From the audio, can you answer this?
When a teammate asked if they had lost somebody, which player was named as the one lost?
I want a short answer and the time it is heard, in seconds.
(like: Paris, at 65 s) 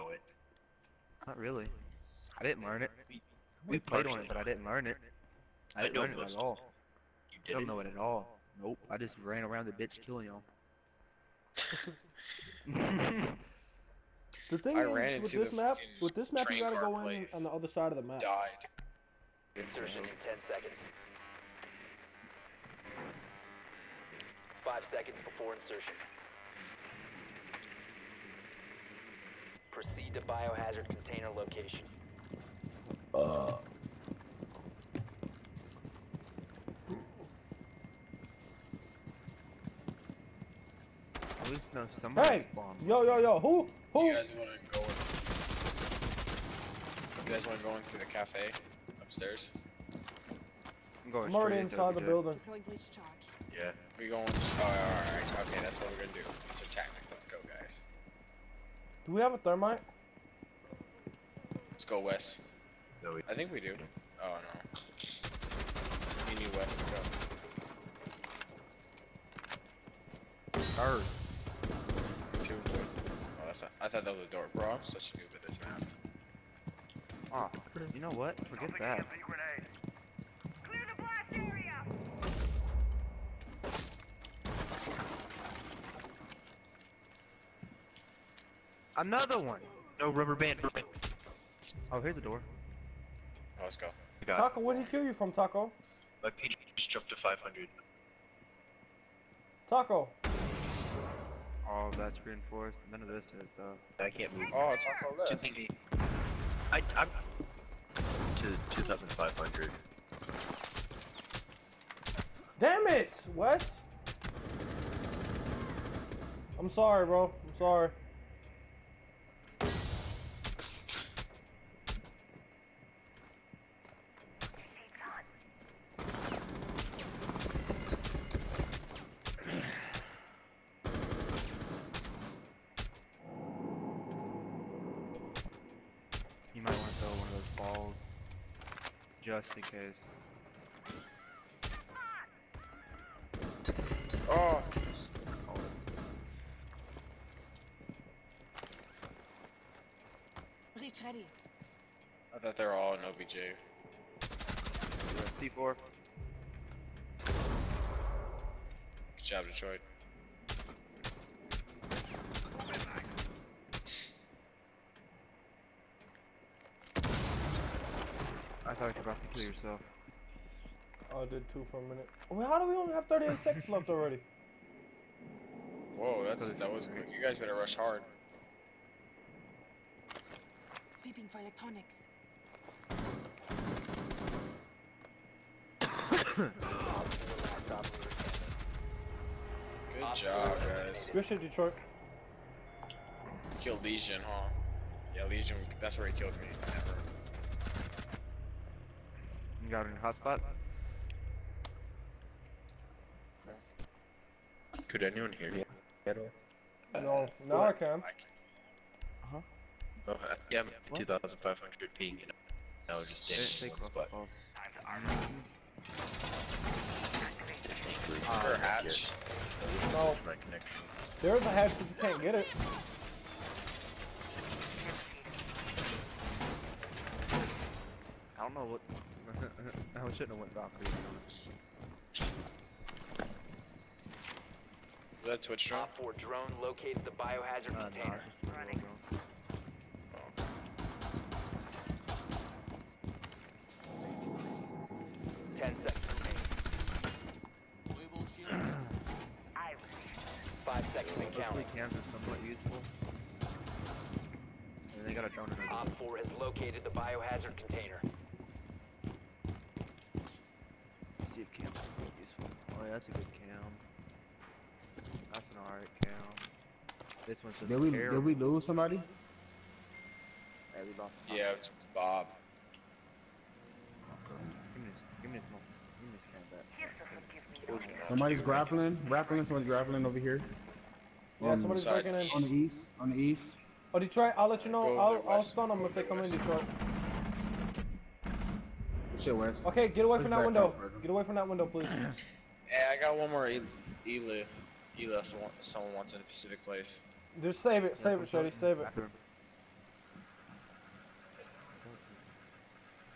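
Bob, at 271 s.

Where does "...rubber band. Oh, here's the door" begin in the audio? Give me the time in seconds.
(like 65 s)
90 s.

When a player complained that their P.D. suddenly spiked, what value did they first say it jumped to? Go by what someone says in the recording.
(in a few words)
500.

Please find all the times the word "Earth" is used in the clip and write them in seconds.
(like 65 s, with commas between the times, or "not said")
70 s.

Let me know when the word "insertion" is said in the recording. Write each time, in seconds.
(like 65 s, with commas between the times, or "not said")
19 s, 25 s.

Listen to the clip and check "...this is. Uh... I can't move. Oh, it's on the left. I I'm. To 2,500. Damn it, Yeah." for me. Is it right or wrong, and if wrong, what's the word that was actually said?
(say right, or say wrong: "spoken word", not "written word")
wrong: "Wes", not "Yeah".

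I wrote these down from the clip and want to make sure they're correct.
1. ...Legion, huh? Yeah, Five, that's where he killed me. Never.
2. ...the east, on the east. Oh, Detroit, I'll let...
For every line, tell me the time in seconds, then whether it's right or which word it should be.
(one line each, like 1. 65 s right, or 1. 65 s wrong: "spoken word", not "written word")
1. 193 s wrong: "Legion", not "Five"
2. 282 s right.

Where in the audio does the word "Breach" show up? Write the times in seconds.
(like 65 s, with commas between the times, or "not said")
150 s.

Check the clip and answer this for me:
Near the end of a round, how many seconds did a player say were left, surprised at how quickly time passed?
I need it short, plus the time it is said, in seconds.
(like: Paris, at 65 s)
38, at 173 s.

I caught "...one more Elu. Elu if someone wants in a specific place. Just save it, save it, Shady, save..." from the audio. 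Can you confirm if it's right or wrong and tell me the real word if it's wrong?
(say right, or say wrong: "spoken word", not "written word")
right.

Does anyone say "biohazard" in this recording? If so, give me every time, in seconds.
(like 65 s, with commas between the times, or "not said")
30 s, 237 s, 256 s.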